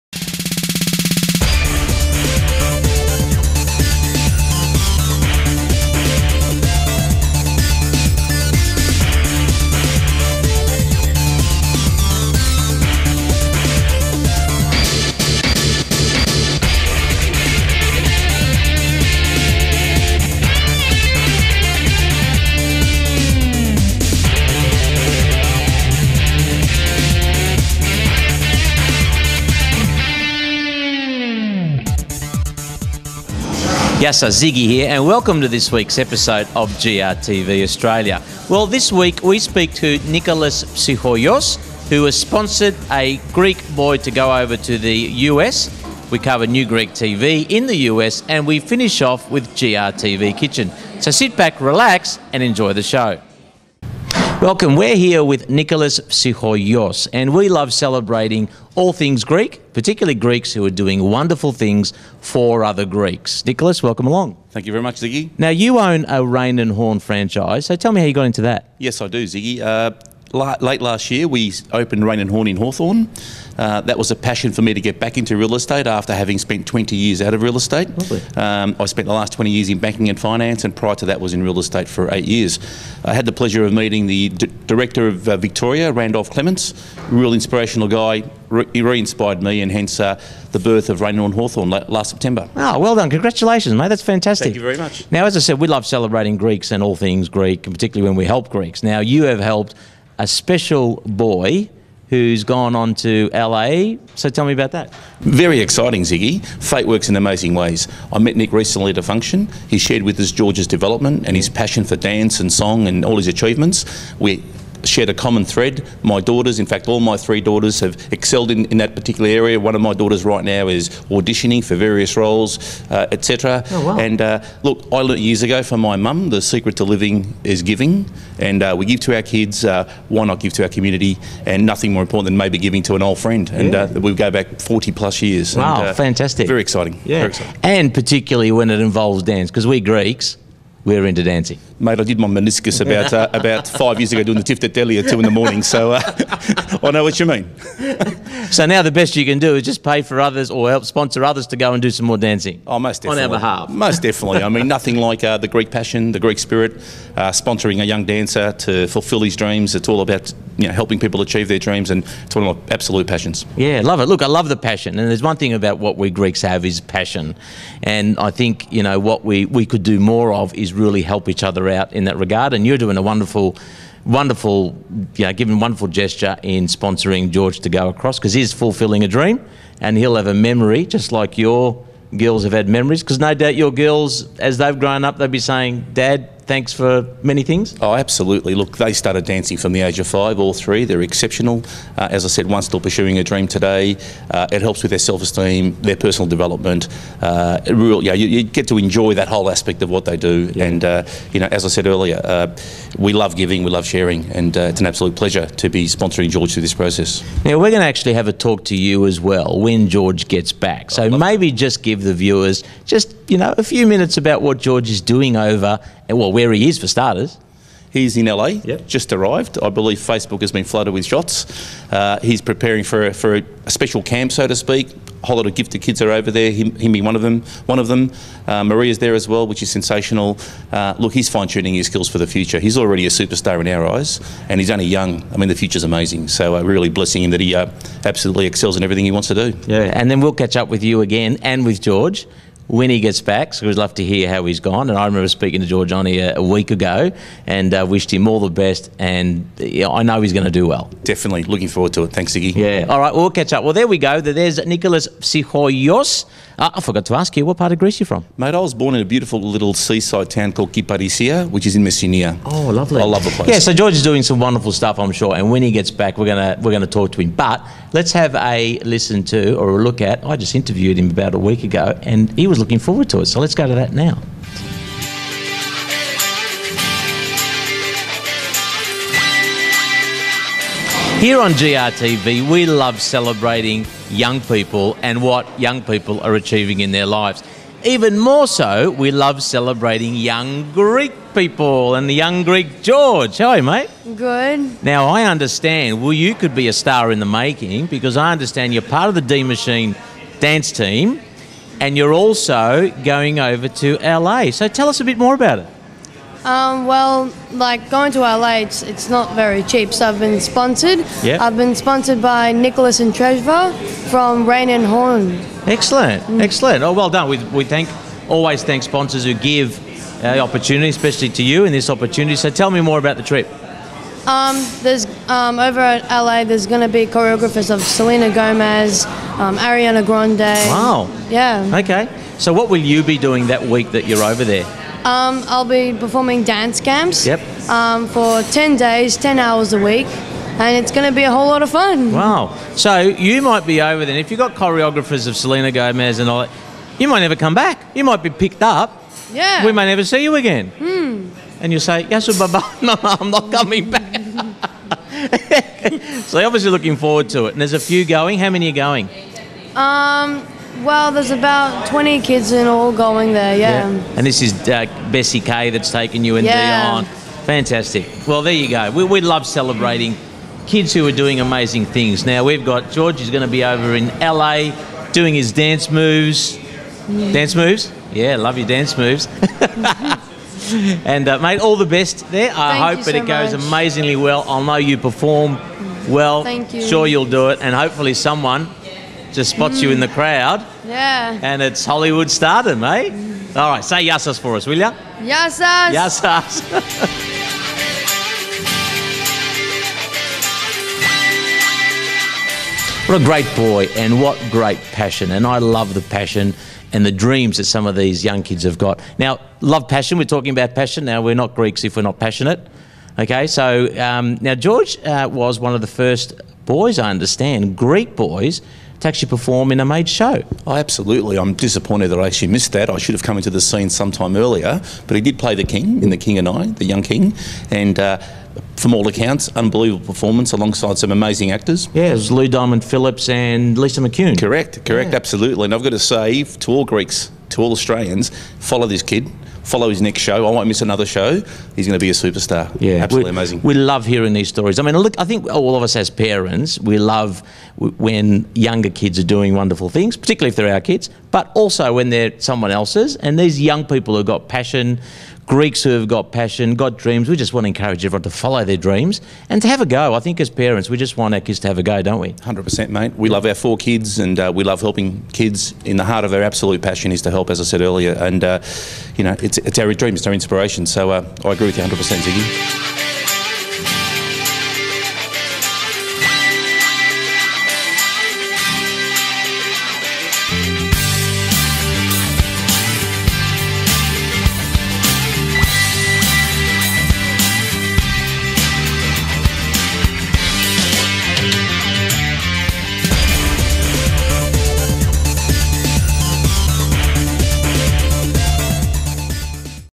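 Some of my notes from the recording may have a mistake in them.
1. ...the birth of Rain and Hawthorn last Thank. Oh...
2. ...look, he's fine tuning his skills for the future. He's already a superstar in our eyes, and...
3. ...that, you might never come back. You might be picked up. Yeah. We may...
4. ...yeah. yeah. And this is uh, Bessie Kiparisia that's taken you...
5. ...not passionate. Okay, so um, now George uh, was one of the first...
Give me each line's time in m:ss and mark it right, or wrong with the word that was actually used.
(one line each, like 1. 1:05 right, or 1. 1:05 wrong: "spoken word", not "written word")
1. 1:30 wrong: "September", not "Thank"
2. 3:50 right
3. 5:46 right
4. 6:03 wrong: "Kay", not "Kiparisia"
5. 6:52 right.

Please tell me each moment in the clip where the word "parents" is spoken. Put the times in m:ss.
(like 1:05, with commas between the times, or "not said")
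7:26, 7:40.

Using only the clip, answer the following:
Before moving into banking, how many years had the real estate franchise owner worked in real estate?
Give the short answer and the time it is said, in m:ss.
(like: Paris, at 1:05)
8, at 1:22.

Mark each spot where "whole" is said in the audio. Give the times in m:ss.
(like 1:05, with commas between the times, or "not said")
3:19, 3:45, 5:41.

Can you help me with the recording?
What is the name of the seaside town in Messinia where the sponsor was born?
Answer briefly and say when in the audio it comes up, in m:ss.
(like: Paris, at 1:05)
Kiparisia, at 4:20.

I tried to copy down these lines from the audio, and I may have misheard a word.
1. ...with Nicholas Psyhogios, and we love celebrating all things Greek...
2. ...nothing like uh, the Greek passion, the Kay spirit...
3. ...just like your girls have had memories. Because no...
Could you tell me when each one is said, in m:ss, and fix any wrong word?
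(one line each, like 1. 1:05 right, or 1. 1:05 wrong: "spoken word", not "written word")
1. 0:55 right
2. 2:34 wrong: "Greek", not "Kay"
3. 3:00 right.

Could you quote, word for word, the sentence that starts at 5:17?
We, we thank always thank sponsors who give uh, opportunity, especially to you in this opportunity.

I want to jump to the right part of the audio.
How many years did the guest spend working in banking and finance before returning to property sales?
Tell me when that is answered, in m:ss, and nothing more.
1:19.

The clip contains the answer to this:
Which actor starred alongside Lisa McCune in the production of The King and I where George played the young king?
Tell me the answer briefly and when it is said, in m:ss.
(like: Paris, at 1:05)
Lou Diamond Phillips, at 7:12.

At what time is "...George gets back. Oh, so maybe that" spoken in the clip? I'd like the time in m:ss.
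3:29.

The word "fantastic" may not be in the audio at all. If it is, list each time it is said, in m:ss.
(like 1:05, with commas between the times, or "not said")
1:34, 2:15, 6:07.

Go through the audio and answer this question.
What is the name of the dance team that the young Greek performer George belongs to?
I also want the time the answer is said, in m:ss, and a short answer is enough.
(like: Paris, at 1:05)
D Machine, at 4:59.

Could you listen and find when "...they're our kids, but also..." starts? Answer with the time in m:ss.
7:30.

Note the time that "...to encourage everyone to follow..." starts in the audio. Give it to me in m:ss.
7:37.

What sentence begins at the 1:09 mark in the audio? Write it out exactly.
Uh, late last year, we opened Raine and Horne in Hawthorn.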